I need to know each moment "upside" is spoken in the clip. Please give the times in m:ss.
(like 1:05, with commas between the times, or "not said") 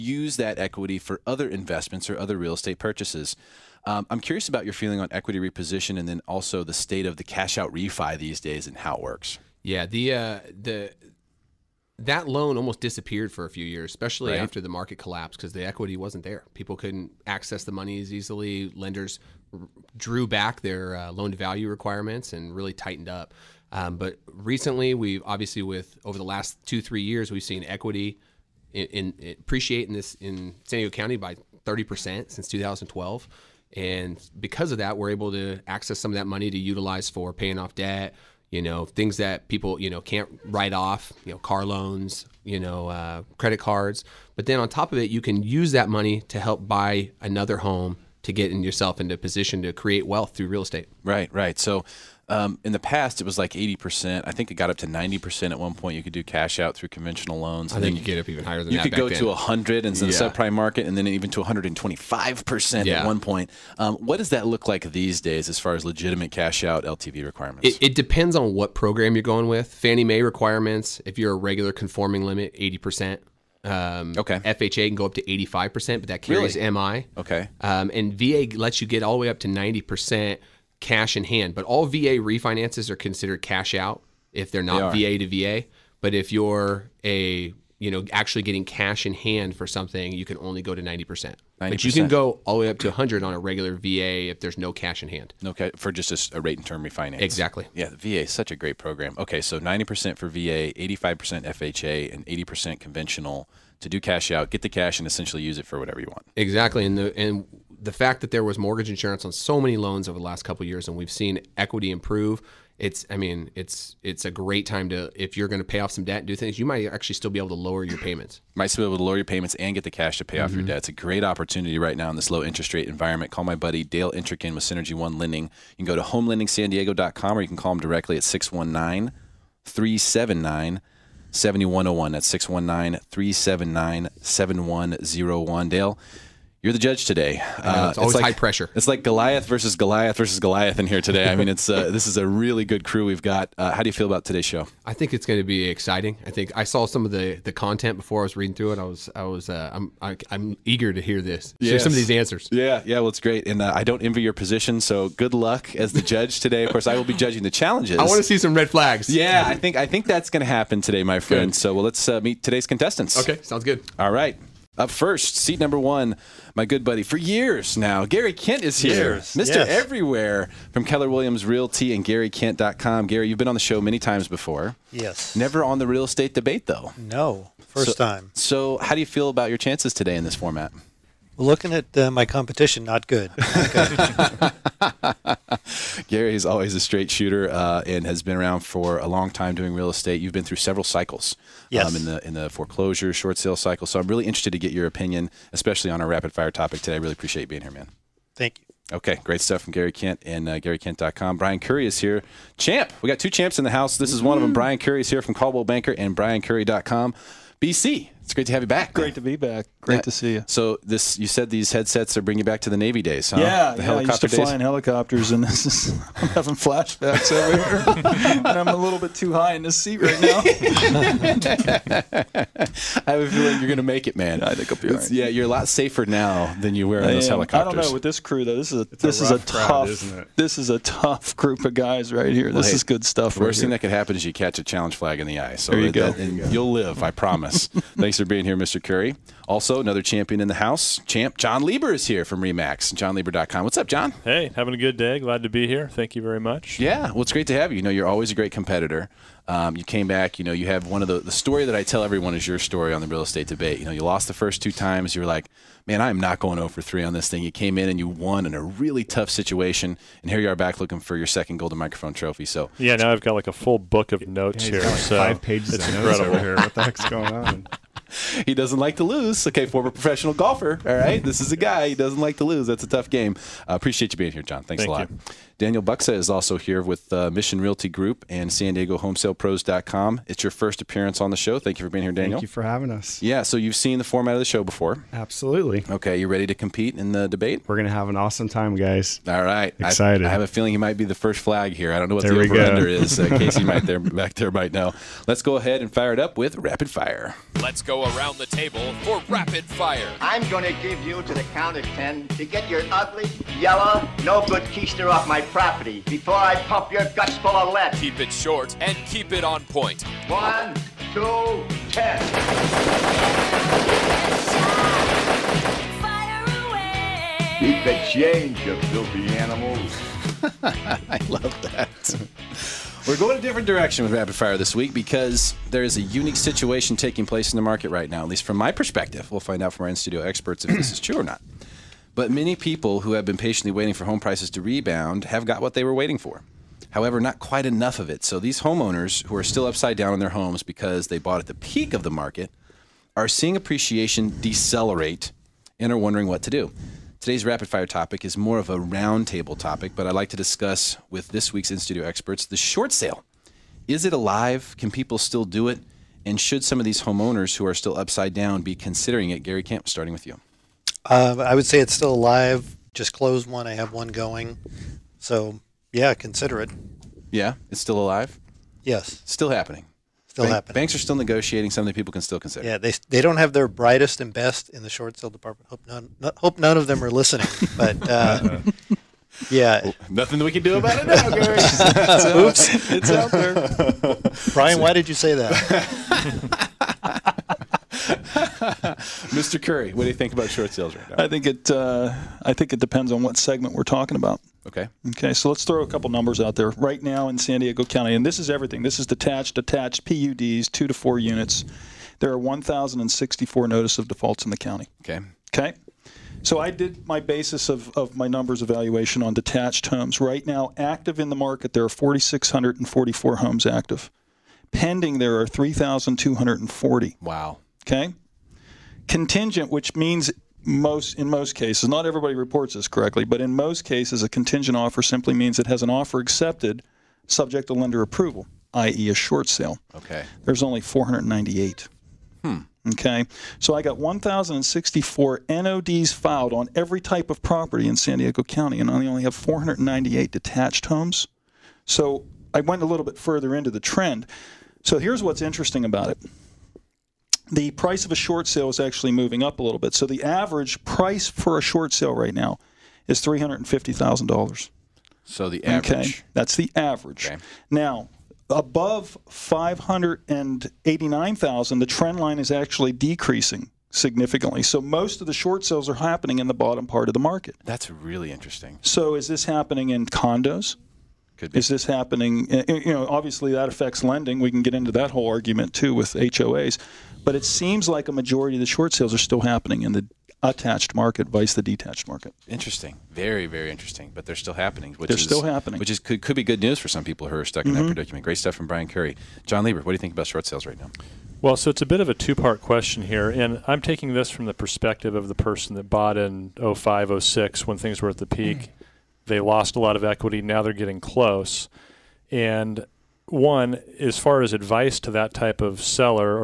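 5:39, 5:57.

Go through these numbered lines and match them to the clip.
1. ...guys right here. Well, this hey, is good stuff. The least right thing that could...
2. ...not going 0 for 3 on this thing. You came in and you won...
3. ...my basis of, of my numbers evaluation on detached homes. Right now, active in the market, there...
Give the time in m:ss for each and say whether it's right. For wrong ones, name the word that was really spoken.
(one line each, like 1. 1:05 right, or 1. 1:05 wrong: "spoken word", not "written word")
1. 3:51 wrong: "worst", not "least"
2. 4:16 right
3. 6:47 right.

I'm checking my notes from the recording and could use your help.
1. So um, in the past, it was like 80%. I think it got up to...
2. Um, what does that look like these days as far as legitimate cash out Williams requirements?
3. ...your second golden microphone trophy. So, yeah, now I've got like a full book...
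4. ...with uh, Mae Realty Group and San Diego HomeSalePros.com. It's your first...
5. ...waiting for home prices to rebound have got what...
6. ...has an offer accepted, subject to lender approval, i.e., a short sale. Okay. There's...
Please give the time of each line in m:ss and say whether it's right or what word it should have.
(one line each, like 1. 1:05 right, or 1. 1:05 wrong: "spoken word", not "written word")
1. 0:51 right
2. 1:03 wrong: "LTV", not "Williams"
3. 4:21 right
4. 4:36 wrong: "Mission", not "Mae"
5. 5:33 right
6. 7:05 right.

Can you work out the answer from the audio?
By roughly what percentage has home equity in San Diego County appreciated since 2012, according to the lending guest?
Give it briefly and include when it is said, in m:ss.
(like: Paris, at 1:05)
30 percent, at 0:31.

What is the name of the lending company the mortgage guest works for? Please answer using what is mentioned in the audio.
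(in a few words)
Synergy One Lending.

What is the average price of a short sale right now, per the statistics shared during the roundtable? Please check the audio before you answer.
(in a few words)
$350,000.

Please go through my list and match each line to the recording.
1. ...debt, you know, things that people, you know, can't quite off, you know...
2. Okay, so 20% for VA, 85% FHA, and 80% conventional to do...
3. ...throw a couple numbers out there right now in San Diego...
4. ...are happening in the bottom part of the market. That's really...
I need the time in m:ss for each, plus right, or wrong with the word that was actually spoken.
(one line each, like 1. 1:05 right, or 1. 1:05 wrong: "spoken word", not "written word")
1. 0:37 wrong: "write", not "quite"
2. 1:39 wrong: "90", not "20"
3. 6:35 right
4. 7:45 right.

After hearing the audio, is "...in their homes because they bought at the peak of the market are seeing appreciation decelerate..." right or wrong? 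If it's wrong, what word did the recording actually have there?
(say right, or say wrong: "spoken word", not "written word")
right.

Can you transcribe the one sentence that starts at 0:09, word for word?
Yeah, the uh, the that loan almost disappeared for a few years, especially right.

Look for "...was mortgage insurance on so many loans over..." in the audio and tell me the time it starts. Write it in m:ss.
1:48.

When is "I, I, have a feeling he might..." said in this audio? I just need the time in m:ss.
4:50.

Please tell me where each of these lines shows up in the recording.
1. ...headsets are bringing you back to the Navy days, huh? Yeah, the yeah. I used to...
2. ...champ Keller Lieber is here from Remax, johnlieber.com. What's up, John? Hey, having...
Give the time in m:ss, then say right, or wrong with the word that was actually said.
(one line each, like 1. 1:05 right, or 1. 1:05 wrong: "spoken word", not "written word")
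1. 3:31 right
2. 4:01 wrong: "John", not "Keller".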